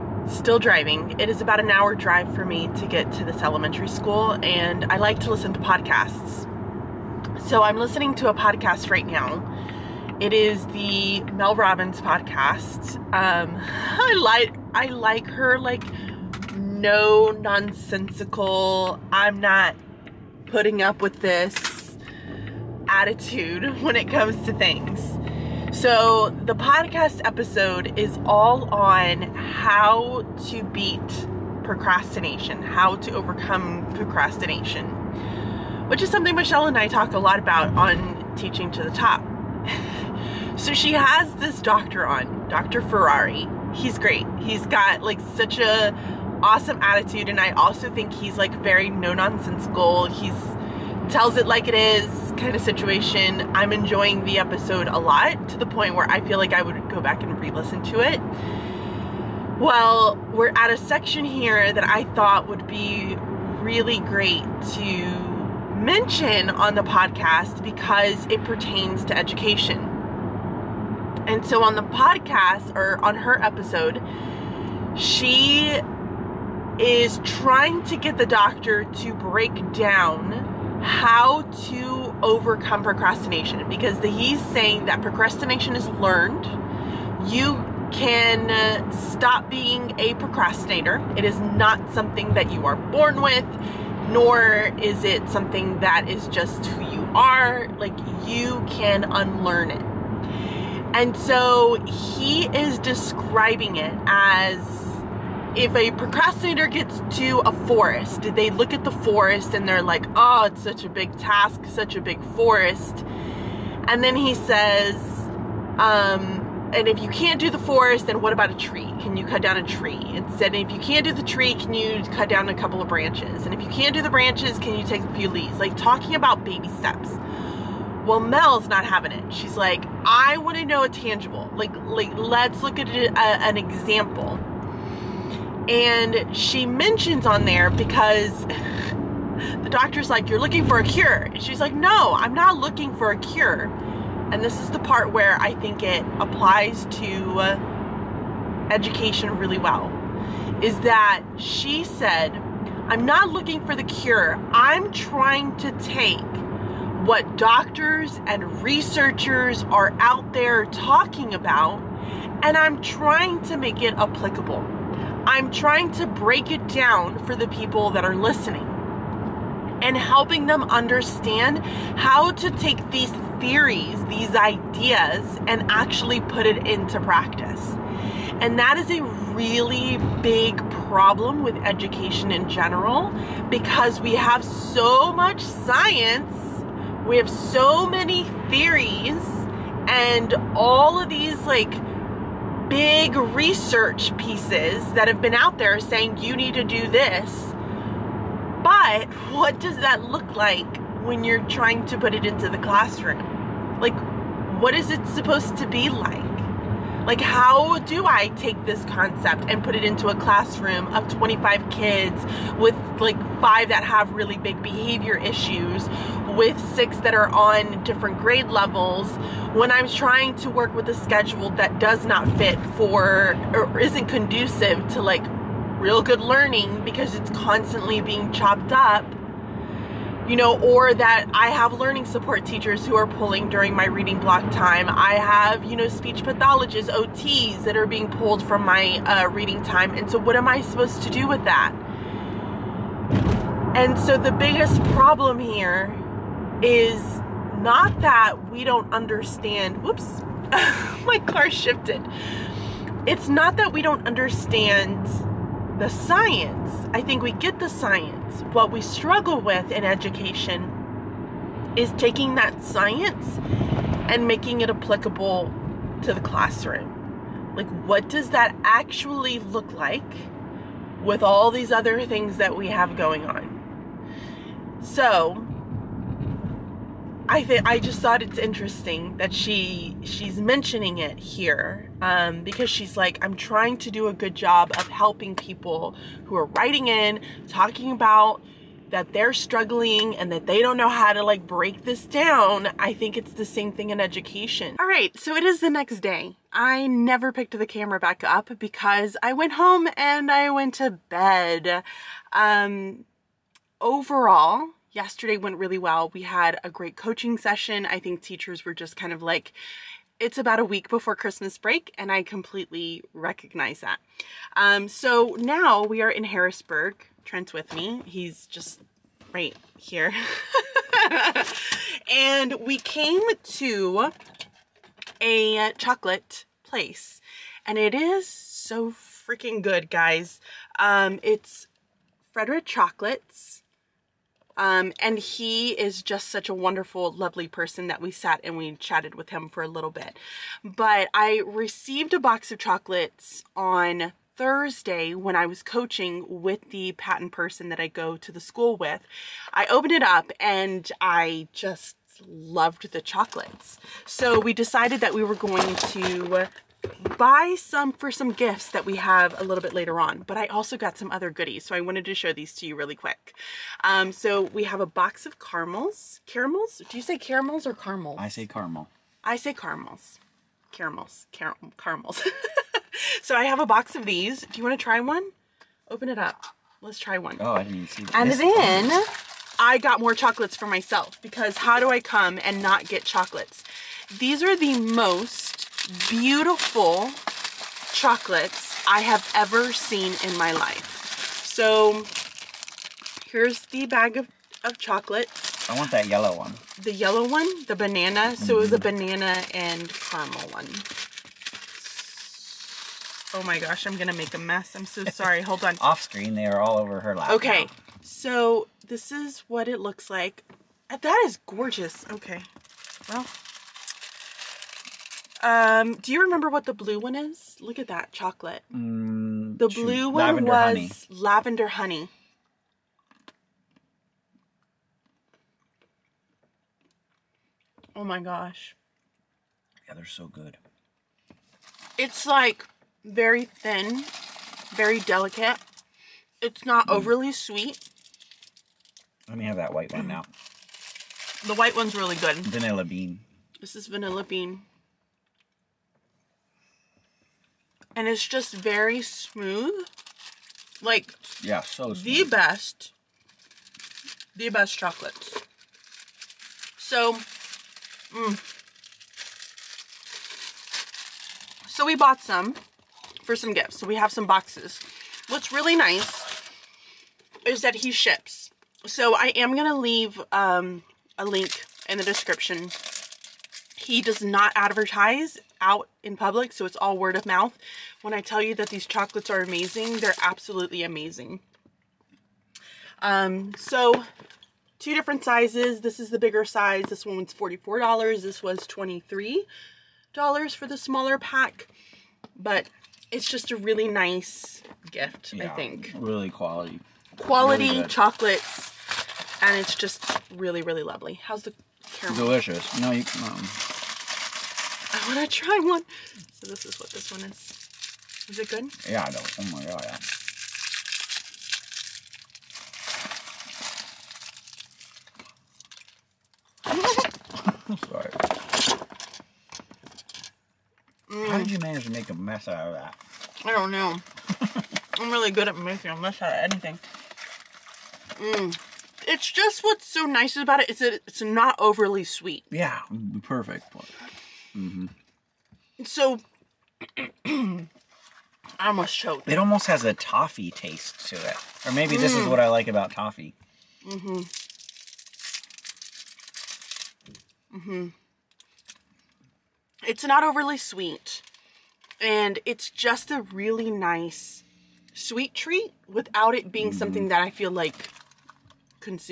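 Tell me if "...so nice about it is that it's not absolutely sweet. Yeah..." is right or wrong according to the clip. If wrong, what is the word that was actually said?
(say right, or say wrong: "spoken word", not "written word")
wrong: "overly", not "absolutely".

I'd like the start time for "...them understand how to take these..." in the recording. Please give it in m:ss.
2:50.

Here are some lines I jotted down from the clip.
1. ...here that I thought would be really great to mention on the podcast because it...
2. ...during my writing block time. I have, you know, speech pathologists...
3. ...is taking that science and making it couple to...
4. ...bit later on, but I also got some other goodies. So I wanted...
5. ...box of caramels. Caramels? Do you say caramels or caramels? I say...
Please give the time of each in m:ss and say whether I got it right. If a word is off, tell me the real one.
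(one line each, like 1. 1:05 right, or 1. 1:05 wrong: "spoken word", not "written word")
1. 1:01 right
2. 3:53 wrong: "reading", not "writing"
3. 4:21 wrong: "applicable", not "couple"
4. 5:59 right
5. 6:04 right.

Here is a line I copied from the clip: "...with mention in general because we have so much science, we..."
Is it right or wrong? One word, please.
wrong.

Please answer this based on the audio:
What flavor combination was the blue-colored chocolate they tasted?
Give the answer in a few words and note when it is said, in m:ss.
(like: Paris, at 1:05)
Lavender honey, at 7:01.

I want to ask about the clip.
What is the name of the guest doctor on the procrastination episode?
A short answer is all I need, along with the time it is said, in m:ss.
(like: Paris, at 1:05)
Dr. Ferrari, at 0:42.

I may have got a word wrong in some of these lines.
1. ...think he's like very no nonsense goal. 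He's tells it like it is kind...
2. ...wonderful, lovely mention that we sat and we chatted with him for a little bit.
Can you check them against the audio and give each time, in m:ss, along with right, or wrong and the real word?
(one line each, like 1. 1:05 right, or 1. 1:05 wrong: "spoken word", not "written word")
1. 0:47 right
2. 5:36 wrong: "person", not "mention".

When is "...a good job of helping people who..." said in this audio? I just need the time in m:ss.
4:44.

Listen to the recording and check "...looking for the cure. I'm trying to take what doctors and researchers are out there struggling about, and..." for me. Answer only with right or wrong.
wrong.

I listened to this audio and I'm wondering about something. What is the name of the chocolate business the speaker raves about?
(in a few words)
Frederic Chocolates.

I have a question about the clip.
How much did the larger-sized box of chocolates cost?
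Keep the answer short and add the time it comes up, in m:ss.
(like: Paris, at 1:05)
$44, at 8:07.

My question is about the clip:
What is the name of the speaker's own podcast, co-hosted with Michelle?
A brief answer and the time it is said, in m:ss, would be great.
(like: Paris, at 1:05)
Teaching to the Top, at 0:38.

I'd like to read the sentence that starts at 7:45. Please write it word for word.
What's really nice is that he ships.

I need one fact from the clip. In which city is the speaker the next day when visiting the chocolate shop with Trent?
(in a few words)
Harrisburg.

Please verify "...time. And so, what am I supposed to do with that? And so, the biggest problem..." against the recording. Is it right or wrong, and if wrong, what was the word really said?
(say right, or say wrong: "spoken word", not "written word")
right.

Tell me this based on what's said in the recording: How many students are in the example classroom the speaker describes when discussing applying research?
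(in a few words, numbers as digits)
25.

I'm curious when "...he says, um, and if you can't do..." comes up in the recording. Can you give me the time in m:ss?
1:54.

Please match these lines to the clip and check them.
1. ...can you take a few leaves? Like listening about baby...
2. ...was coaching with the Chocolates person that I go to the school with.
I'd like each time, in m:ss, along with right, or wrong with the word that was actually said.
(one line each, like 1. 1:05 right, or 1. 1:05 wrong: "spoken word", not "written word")
1. 2:04 wrong: "talking", not "listening"
2. 5:45 wrong: "PaTTAN", not "Chocolates".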